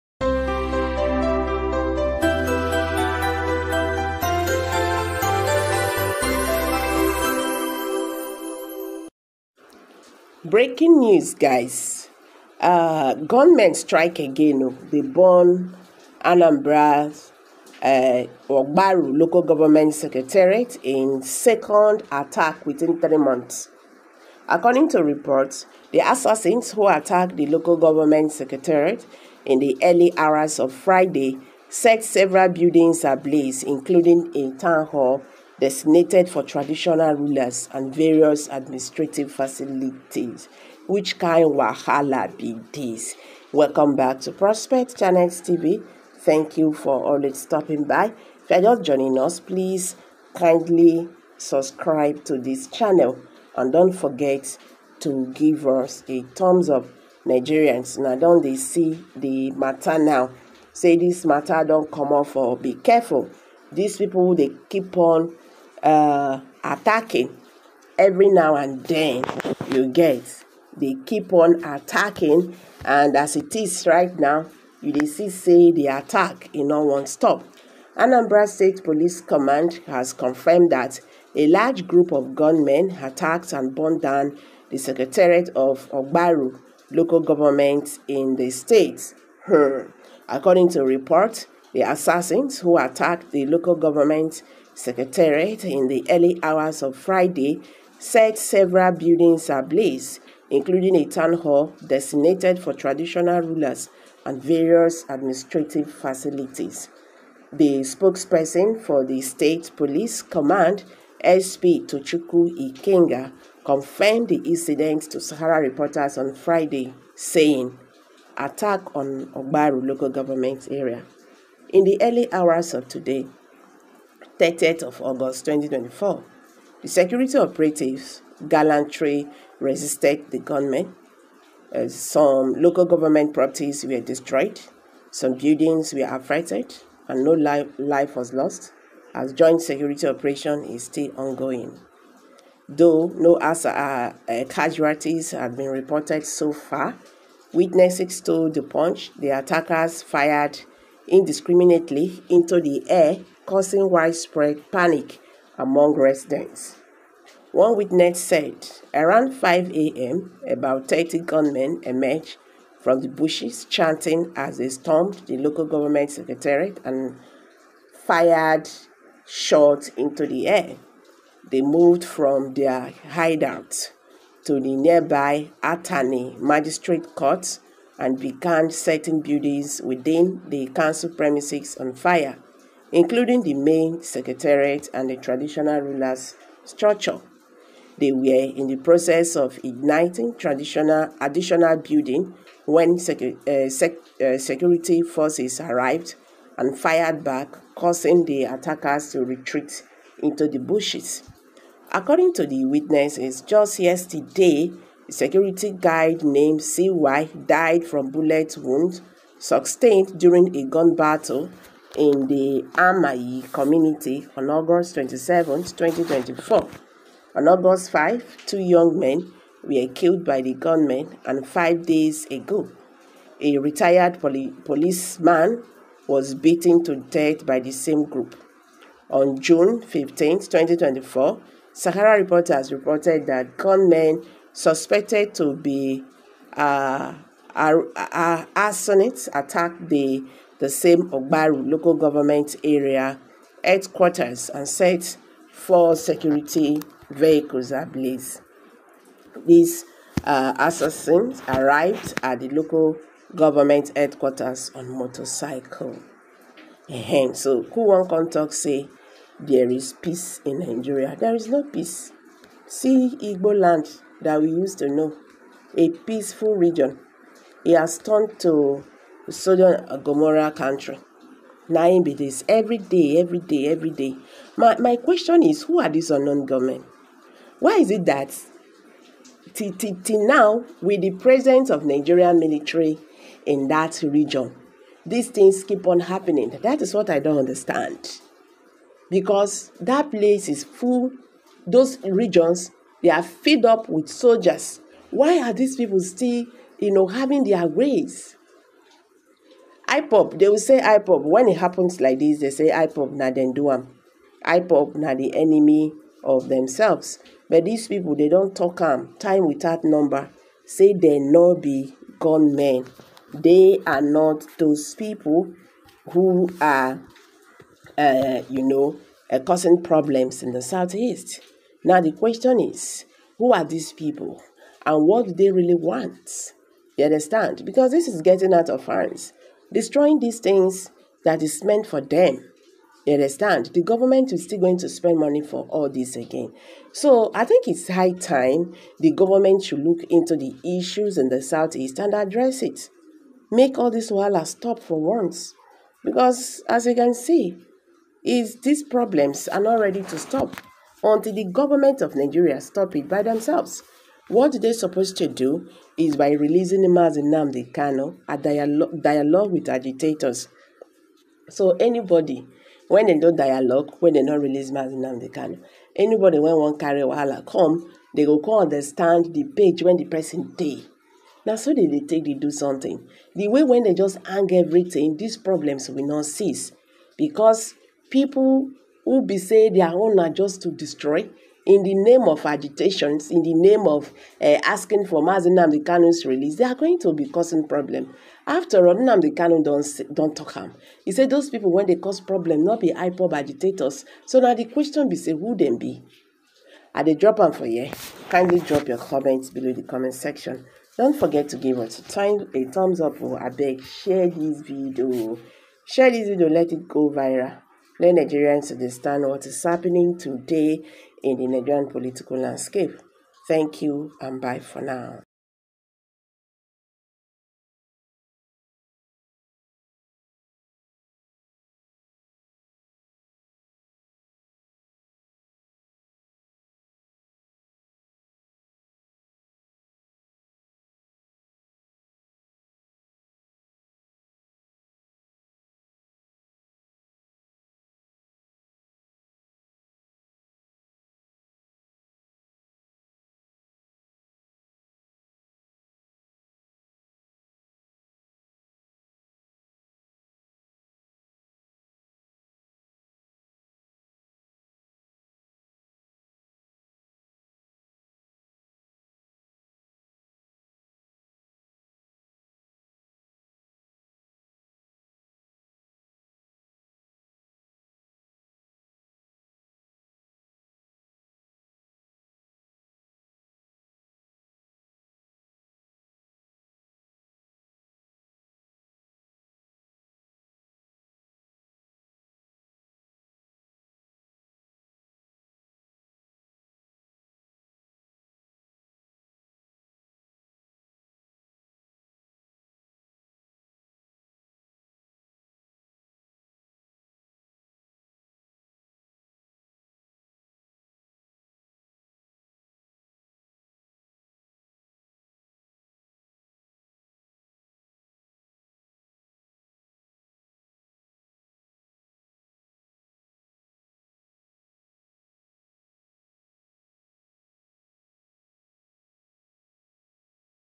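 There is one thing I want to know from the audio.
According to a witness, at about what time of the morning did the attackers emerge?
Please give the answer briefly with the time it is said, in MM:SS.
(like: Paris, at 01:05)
5 a.m., at 02:38.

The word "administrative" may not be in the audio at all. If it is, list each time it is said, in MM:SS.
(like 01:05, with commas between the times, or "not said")
00:38, 01:45.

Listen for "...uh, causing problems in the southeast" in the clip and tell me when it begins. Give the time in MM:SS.
05:19.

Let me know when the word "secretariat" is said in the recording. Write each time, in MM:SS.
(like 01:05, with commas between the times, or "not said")
00:19, 00:28, 01:24, 01:34, 02:46, 03:04.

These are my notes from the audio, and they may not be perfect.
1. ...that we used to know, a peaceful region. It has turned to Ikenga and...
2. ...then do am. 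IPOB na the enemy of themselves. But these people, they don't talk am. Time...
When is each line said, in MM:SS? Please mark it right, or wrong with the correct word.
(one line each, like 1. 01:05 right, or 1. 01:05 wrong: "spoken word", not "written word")
1. 04:24 wrong: "Sodom", not "Ikenga"
2. 05:03 right.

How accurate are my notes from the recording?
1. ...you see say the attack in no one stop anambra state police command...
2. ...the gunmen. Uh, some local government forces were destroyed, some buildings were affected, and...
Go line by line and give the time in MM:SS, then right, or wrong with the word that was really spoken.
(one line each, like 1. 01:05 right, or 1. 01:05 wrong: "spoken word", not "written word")
1. 01:14 right
2. 02:10 wrong: "properties", not "forces".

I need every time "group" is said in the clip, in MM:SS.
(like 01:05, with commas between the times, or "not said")
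01:21, 03:48.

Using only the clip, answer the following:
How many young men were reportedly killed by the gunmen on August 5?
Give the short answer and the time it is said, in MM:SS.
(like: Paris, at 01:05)
2, at 03:38.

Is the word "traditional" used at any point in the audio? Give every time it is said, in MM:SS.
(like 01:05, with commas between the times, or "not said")
00:36, 01:42, 03:05, 03:10.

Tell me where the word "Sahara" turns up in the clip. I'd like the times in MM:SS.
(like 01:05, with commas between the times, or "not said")
01:55, 03:51.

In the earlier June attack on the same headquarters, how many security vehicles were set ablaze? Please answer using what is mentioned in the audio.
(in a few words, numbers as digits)
4.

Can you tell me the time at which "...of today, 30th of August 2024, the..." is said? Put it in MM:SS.
02:02.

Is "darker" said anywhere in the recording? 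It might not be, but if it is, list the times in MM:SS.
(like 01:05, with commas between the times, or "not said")
not said.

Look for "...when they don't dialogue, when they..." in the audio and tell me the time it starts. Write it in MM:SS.
06:02.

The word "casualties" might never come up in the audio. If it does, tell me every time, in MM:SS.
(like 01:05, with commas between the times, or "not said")
02:24.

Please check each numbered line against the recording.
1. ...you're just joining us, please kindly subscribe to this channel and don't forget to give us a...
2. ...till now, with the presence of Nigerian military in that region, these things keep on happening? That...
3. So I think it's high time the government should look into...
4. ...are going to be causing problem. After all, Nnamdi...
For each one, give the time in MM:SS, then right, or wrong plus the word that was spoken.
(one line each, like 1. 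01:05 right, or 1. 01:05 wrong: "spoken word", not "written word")
1. 00:48 right
2. 04:40 right
3. 05:36 right
4. 06:26 right.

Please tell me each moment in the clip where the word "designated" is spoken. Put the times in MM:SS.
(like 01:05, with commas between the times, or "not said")
00:35, 01:41.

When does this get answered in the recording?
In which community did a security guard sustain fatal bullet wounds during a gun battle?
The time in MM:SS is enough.
03:32.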